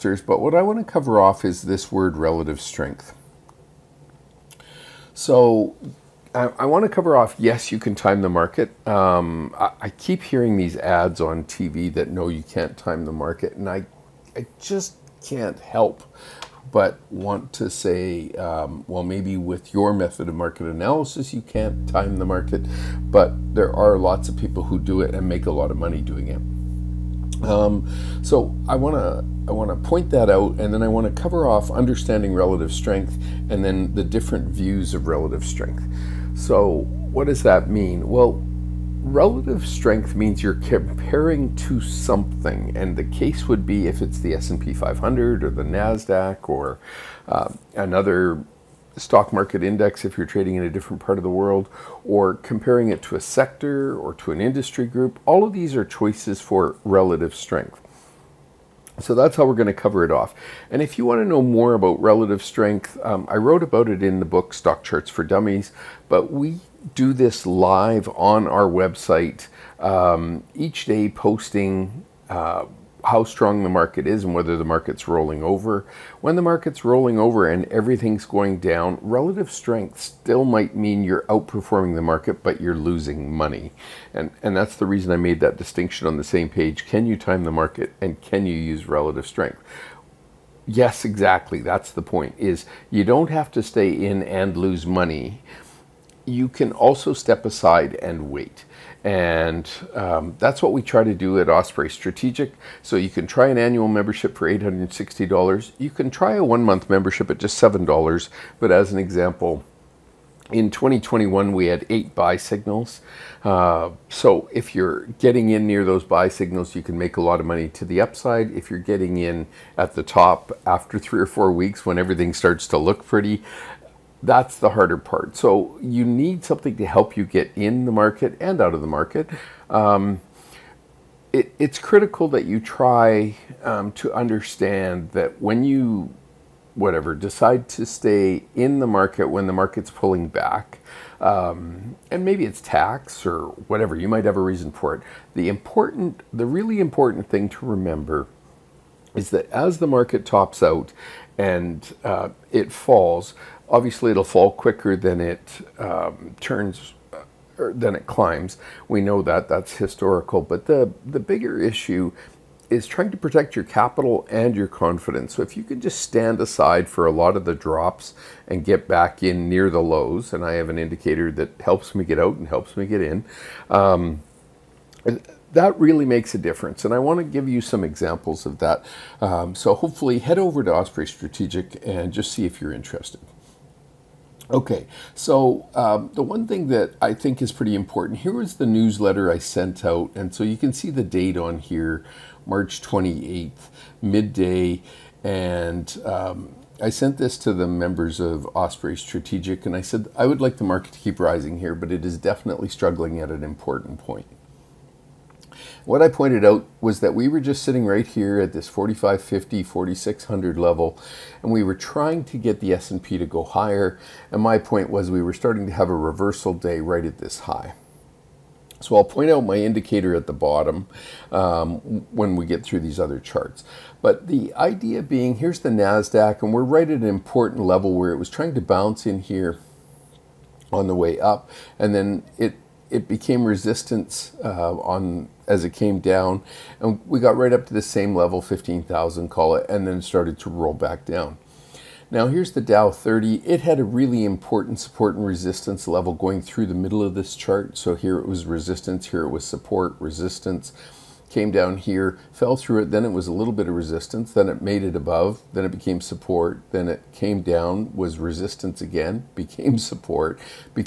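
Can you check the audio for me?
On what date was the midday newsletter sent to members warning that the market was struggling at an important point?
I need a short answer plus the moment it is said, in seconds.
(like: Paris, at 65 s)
March 28th, at 192 s.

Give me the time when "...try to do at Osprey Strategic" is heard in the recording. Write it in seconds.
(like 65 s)
100 s.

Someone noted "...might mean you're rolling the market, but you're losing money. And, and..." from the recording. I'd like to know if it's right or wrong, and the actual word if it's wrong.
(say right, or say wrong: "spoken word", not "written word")
wrong: "outperforming", not "rolling".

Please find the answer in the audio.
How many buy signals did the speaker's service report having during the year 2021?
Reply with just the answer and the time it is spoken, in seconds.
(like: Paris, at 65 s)
8, at 111 s.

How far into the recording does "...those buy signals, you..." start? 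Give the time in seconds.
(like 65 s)
115 s.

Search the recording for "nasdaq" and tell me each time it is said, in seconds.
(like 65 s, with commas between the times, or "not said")
45 s, 225 s.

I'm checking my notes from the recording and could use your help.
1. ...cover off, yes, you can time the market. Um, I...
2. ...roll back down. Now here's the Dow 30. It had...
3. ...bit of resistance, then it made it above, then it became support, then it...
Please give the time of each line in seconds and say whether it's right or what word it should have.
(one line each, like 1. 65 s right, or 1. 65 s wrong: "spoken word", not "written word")
1. 6 s right
2. 240 s right
3. 253 s right.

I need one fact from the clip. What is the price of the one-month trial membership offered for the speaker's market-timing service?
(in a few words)
$7.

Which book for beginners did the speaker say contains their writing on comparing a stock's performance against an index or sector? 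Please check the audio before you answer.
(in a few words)
Stock Charts for Dummies.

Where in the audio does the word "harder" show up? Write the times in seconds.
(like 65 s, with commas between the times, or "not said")
124 s.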